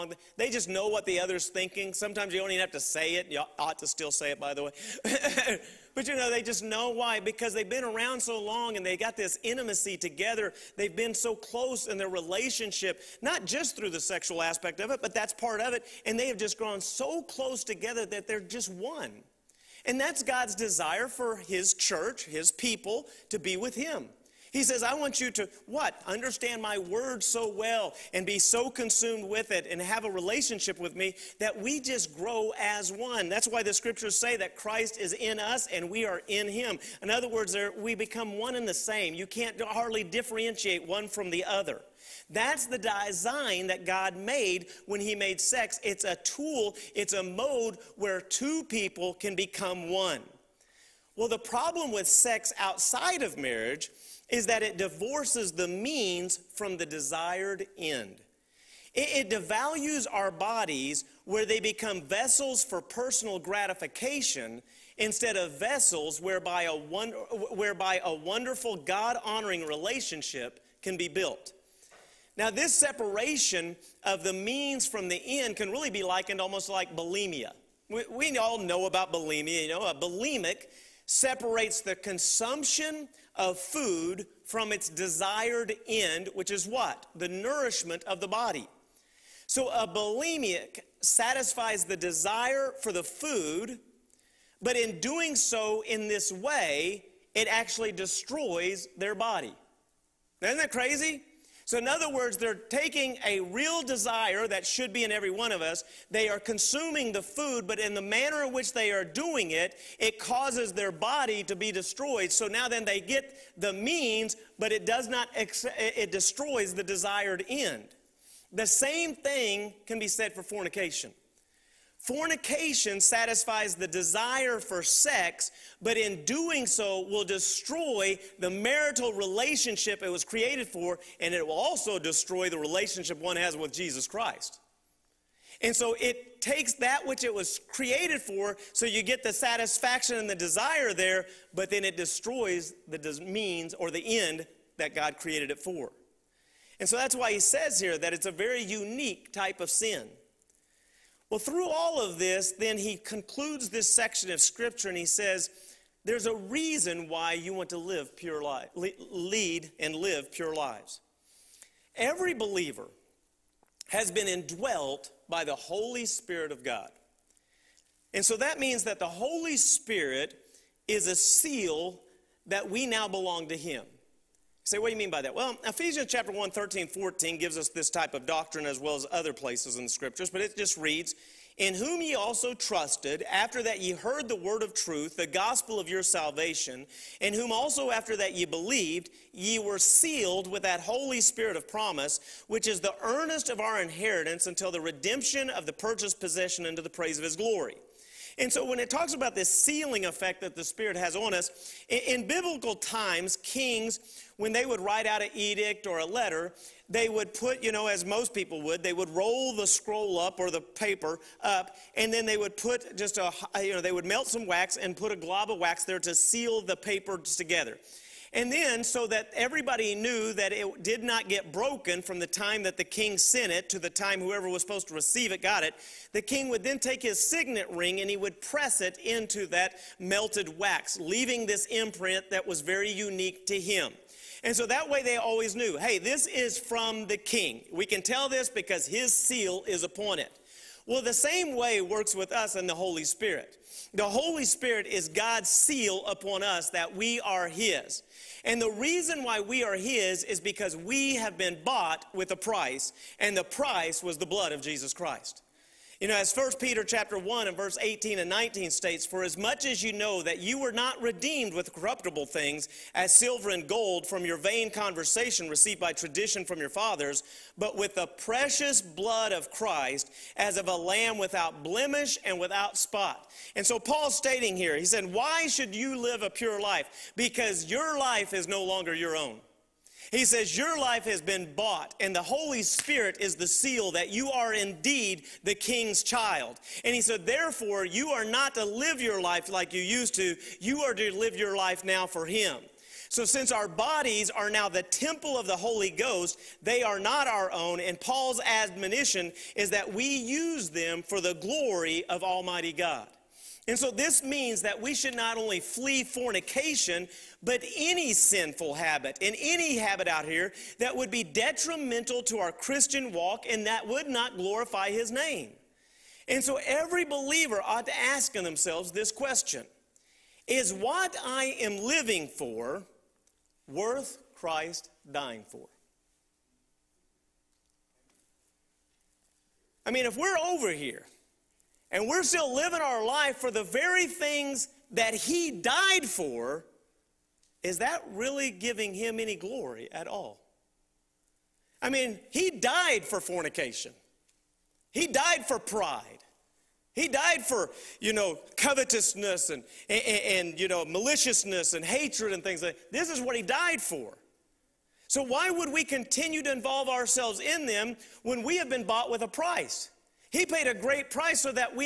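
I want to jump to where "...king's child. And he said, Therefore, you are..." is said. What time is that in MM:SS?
04:45.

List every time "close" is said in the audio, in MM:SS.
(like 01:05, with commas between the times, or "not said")
00:11, 00:17.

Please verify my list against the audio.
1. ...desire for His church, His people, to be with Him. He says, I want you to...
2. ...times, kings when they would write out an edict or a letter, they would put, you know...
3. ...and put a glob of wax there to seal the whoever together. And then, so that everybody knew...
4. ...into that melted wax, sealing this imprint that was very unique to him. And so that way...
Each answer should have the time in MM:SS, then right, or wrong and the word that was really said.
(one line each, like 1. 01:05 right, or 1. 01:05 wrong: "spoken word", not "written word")
1. 00:20 right
2. 03:22 right
3. 03:34 wrong: "paper", not "whoever"
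4. 03:49 wrong: "leaving", not "sealing".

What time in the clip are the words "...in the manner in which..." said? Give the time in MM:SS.
01:47.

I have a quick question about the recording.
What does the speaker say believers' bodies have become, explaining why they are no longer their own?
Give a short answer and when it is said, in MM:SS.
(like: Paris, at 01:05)
temple of the Holy Ghost, at 04:54.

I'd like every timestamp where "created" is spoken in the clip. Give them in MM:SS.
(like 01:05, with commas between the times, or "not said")
02:10, 02:17, 02:25.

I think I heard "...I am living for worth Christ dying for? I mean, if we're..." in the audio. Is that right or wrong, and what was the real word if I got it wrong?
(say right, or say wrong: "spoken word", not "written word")
right.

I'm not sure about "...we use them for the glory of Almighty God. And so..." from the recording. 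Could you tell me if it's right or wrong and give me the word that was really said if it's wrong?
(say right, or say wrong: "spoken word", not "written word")
right.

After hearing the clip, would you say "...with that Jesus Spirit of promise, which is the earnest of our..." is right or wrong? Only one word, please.
wrong.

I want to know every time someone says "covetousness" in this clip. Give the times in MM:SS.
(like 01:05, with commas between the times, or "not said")
05:48.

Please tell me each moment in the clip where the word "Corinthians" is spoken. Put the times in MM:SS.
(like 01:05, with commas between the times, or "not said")
not said.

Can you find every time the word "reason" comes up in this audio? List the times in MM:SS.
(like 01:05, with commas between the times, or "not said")
02:36, 04:08.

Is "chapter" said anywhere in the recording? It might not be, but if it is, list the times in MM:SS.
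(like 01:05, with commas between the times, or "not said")
02:56, 04:16.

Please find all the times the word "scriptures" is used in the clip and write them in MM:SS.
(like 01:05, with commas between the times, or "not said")
00:33, 02:34, 02:59.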